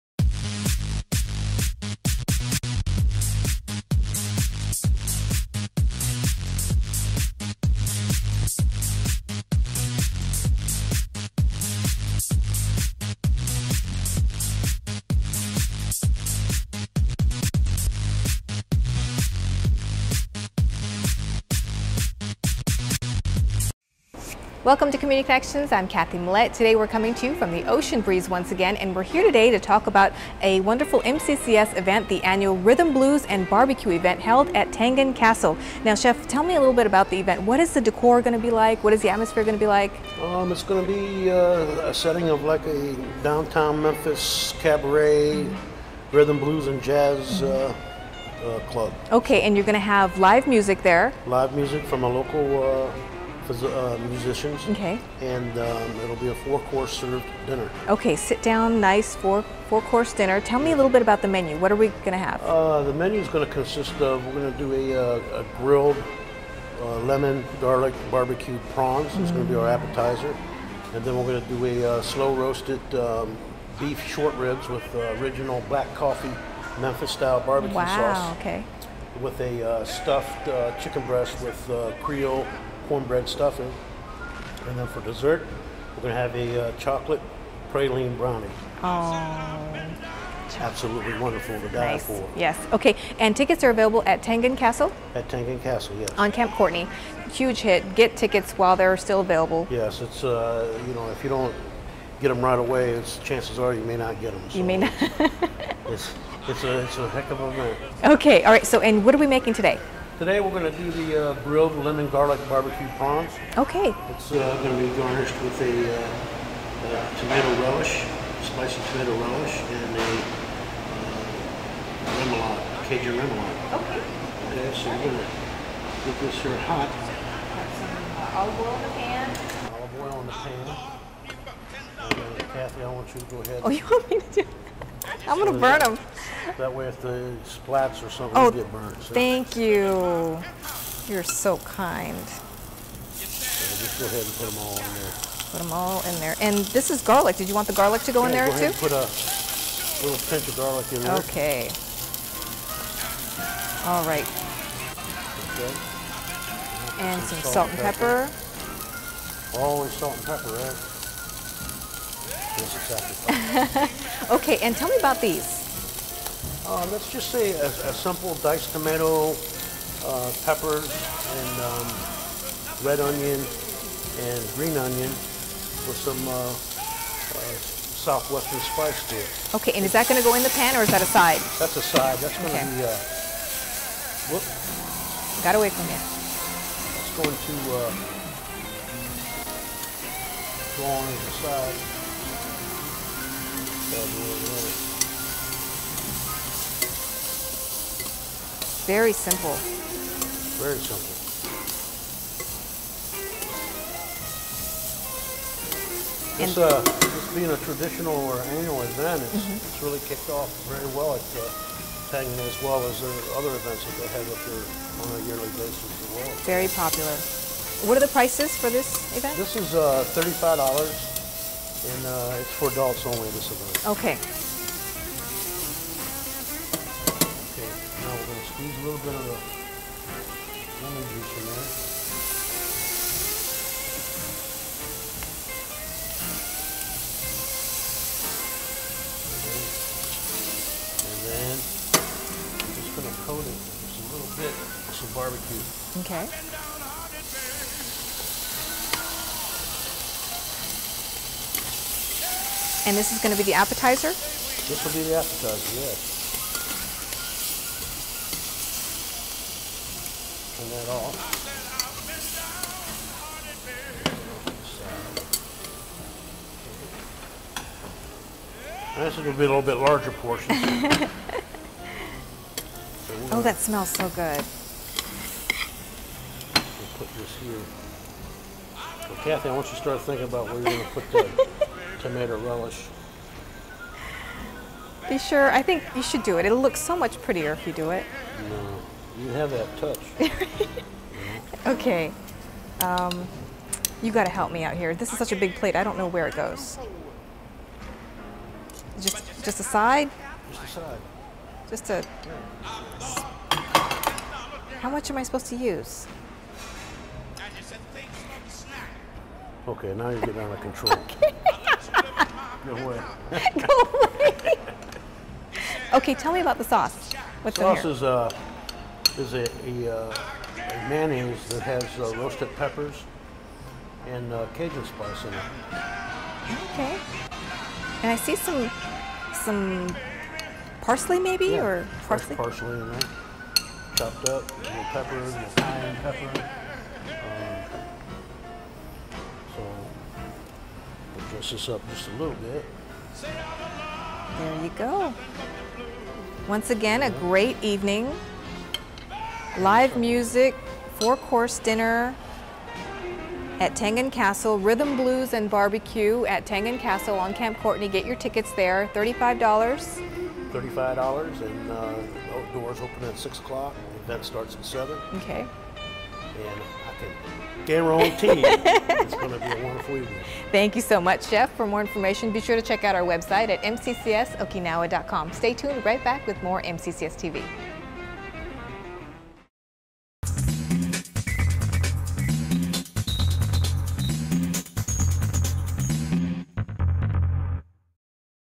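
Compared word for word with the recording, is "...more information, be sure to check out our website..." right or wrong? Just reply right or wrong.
right.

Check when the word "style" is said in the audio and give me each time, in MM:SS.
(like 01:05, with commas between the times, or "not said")
01:17.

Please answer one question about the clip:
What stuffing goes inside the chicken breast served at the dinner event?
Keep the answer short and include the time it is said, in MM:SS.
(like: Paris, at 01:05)
Creole cornbread stuffing, at 01:22.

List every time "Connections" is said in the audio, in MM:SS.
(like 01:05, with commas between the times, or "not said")
00:25.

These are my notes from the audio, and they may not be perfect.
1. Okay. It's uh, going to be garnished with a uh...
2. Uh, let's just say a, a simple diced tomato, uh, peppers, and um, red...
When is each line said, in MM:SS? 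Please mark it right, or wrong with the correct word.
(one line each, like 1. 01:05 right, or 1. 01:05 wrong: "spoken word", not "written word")
1. 01:53 right
2. 02:46 right.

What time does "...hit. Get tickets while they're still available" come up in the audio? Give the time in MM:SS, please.
01:37.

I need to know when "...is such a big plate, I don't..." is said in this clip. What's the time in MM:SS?
04:55.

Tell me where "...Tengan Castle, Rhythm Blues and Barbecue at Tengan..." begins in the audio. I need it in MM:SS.
05:53.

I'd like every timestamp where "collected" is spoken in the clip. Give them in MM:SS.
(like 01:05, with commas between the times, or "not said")
not said.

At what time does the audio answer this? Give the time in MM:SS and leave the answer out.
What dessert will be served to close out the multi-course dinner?
01:26.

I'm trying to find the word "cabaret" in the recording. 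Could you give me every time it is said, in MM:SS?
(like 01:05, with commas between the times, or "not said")
00:44.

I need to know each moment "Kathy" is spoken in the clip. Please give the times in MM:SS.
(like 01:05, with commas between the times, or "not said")
00:25, 02:12, 04:39.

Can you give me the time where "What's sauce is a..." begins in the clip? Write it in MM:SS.
05:17.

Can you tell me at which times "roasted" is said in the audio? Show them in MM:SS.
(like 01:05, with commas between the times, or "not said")
01:12, 05:22.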